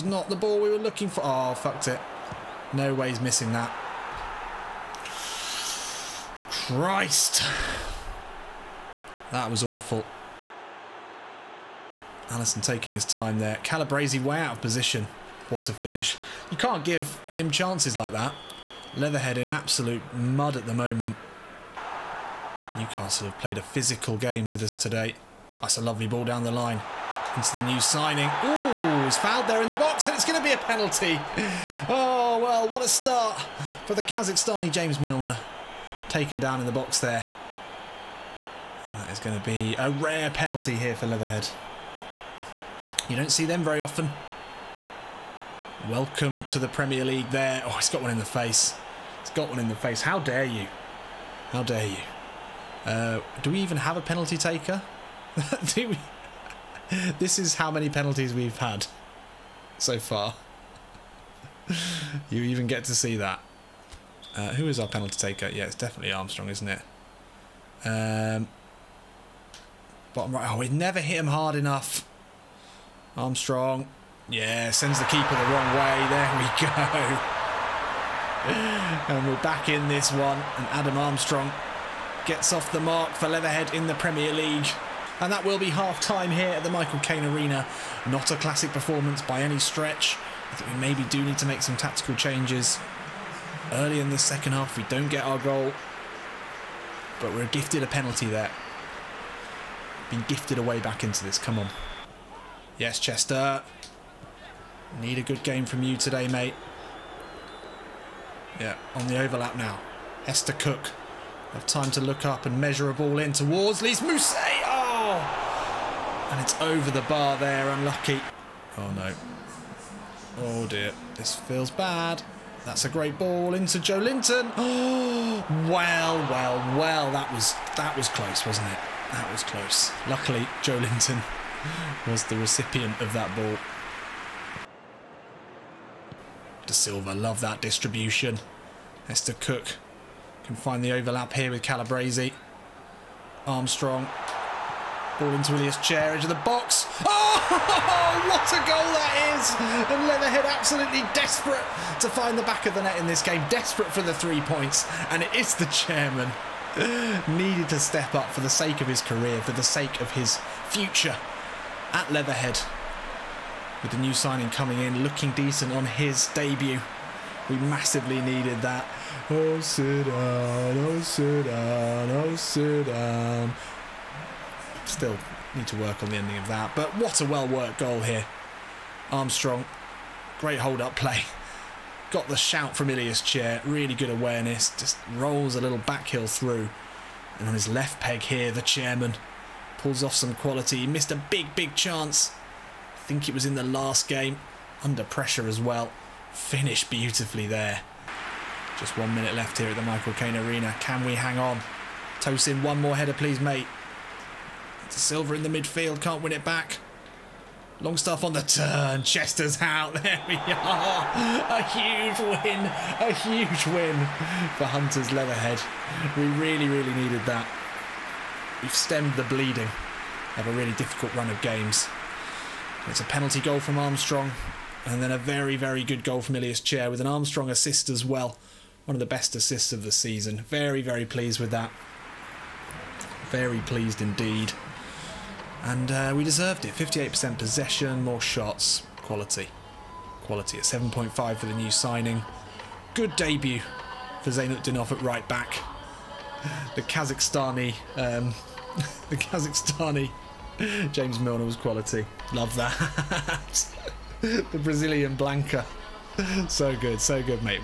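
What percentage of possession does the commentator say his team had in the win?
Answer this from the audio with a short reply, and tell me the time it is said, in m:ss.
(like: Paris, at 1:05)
58%, at 3:56.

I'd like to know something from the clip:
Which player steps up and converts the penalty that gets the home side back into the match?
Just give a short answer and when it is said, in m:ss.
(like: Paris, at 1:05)
Adam Armstrong, at 1:20.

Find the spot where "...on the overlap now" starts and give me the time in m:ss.
1:48.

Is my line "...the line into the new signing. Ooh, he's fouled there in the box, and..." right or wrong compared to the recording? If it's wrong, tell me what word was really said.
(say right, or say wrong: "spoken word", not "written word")
right.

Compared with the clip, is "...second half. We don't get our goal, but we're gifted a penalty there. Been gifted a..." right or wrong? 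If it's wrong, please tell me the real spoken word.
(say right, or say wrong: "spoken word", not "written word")
right.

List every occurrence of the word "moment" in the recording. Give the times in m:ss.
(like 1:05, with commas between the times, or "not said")
0:20.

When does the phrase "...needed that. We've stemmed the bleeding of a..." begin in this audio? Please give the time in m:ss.
3:36.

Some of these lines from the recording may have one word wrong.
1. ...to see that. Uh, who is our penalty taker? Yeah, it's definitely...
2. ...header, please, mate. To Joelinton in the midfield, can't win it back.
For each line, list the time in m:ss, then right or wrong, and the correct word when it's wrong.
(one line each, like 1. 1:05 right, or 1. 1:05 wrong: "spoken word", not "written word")
1. 1:02 right
2. 3:22 wrong: "Silver", not "Joelinton".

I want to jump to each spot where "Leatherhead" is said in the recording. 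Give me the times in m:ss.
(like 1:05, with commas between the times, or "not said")
0:18, 0:41, 1:23, 2:30, 2:42, 3:35.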